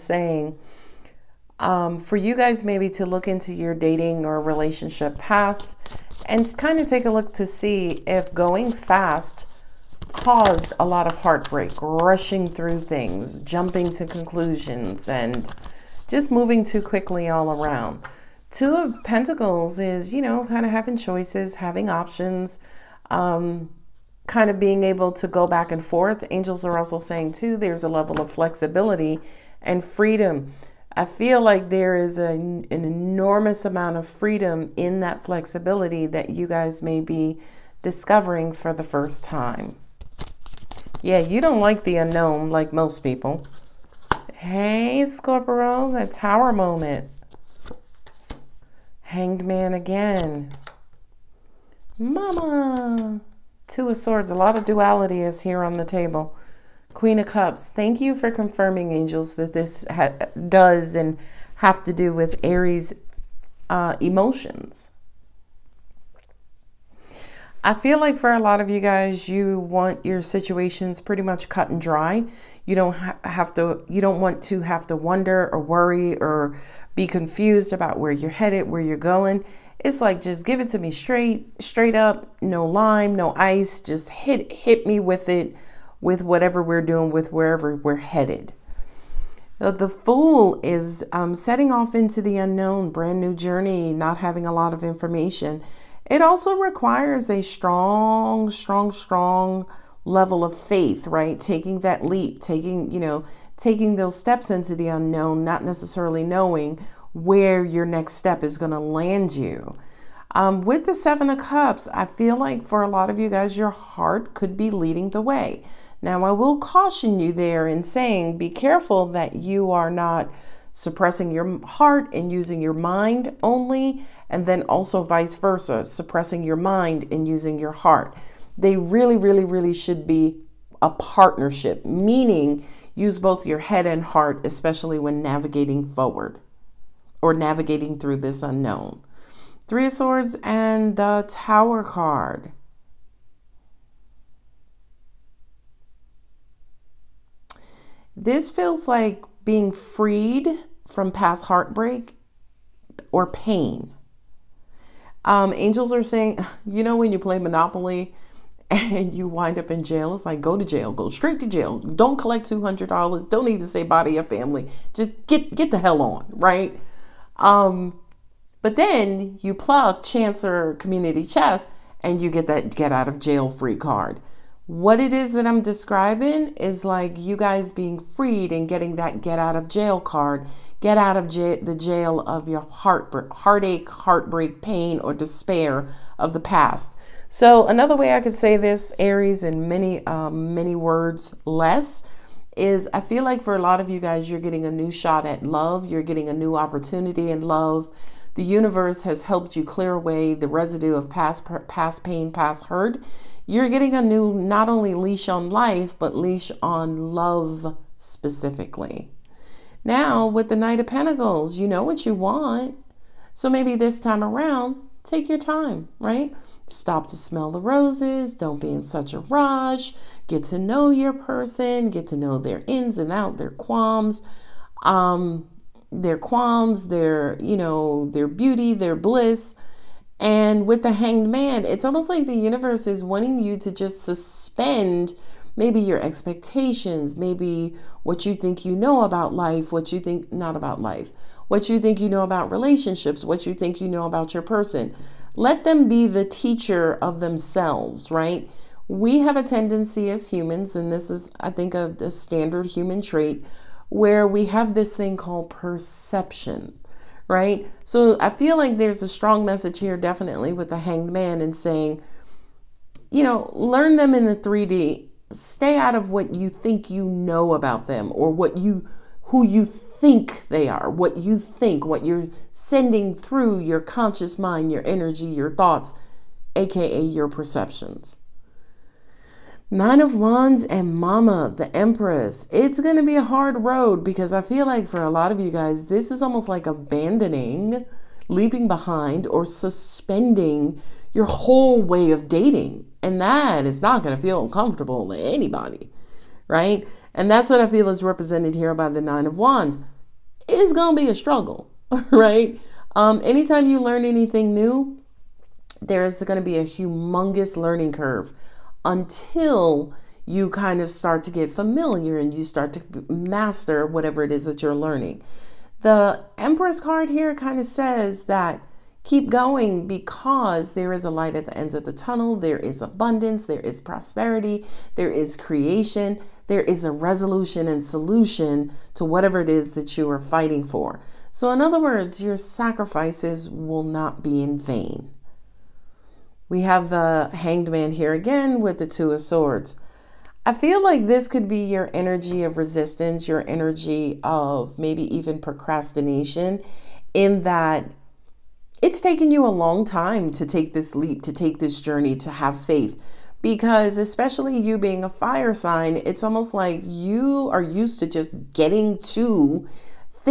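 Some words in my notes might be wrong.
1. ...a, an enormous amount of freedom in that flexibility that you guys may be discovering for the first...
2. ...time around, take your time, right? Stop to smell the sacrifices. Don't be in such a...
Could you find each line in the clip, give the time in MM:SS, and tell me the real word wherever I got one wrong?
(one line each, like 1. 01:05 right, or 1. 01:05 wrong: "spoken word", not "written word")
1. 00:32 right
2. 03:33 wrong: "roses", not "sacrifices".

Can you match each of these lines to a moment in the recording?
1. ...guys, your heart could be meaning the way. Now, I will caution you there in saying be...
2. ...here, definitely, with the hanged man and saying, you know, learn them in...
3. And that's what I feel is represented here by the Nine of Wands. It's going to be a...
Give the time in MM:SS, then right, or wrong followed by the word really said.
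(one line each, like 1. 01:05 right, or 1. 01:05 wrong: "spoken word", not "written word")
1. 01:53 wrong: "leading", not "meaning"
2. 04:19 right
3. 04:57 right.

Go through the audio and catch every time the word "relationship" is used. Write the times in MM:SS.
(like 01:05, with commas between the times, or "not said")
00:04, 04:02.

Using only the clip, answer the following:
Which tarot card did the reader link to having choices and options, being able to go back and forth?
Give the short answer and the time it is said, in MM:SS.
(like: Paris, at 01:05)
Two of Pentacles, at 00:18.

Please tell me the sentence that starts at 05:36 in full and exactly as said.
We have the Hanged Man here again with the Two of Swords.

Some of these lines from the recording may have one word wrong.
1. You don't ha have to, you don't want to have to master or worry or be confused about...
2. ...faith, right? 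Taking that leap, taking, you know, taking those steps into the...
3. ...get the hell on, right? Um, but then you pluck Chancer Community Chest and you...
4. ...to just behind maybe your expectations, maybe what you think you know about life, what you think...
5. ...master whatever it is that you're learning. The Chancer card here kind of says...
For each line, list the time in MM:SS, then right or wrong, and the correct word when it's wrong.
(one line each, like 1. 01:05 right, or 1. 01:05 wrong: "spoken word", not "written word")
1. 01:12 wrong: "wonder", not "master"
2. 01:40 right
3. 02:45 right
4. 03:53 wrong: "suspend", not "behind"
5. 05:13 wrong: "Empress", not "Chancer".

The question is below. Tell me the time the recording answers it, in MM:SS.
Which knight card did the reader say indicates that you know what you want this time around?
03:30.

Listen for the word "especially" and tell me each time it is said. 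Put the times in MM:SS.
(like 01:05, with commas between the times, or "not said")
02:14, 05:53.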